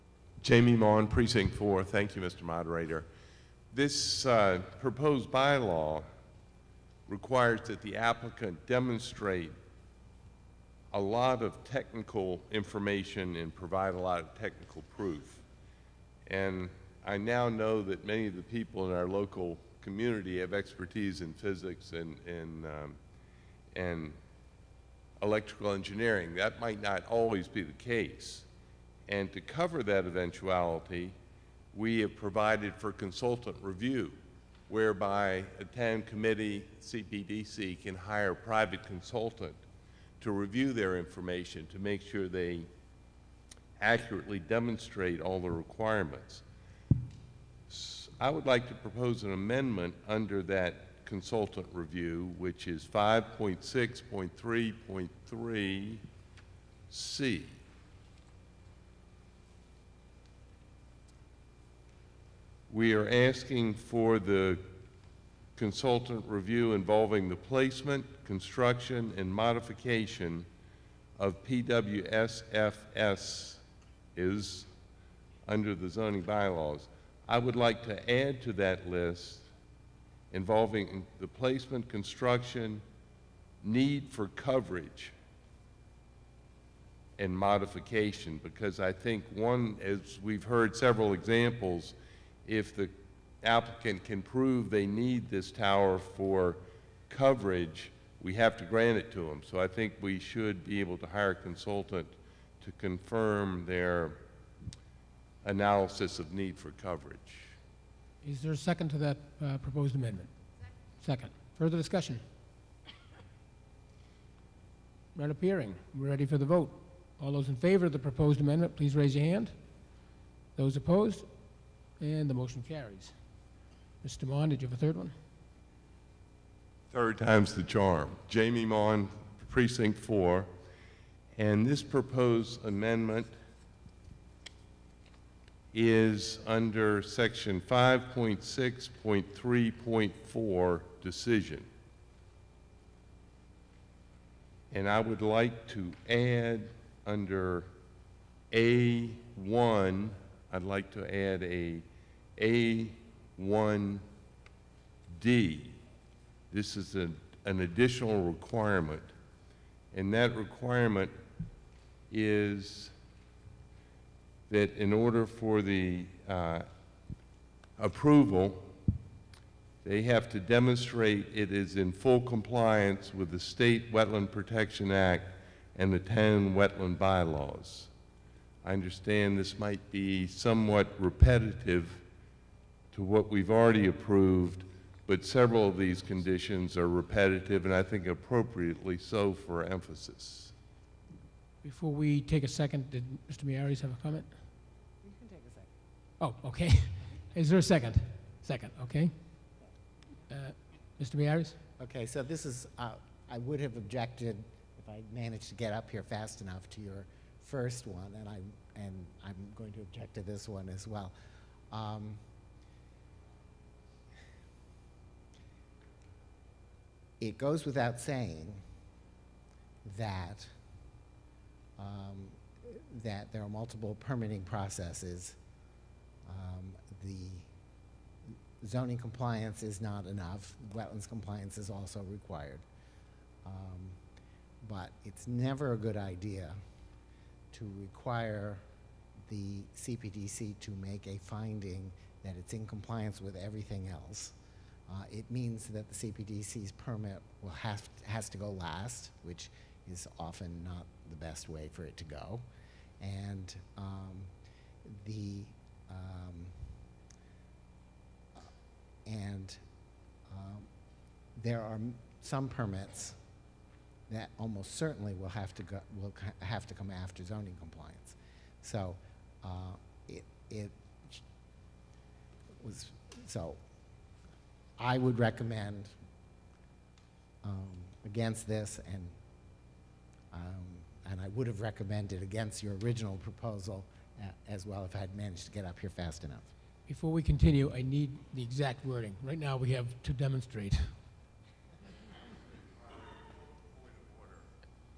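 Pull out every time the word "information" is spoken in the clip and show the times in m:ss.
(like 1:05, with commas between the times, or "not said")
0:12, 0:40.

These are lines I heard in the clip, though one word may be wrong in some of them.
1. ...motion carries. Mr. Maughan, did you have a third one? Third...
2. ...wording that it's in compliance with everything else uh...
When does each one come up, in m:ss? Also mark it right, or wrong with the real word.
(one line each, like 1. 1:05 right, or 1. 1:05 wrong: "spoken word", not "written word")
1. 2:02 right
2. 4:01 wrong: "finding", not "wording".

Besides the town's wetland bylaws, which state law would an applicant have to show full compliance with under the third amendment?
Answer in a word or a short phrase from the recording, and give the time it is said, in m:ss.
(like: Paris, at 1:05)
State Wetland Protection Act, at 2:53.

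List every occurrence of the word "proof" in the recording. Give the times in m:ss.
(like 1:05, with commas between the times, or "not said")
0:14.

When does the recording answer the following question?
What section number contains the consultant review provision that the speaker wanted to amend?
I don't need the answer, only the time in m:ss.
0:52.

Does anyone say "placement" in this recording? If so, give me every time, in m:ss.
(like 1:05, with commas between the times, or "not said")
1:07, 1:21.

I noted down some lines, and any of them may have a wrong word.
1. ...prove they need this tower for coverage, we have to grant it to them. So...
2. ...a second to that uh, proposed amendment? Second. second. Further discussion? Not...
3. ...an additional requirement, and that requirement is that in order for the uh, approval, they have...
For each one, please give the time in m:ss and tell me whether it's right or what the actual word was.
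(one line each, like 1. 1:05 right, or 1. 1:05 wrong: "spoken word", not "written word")
1. 1:34 right
2. 1:48 right
3. 2:37 right.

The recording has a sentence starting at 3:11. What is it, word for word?
Before we take a second, did Mr.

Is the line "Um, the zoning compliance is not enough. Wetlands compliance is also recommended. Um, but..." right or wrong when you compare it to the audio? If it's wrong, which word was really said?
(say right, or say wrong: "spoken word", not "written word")
wrong: "required", not "recommended".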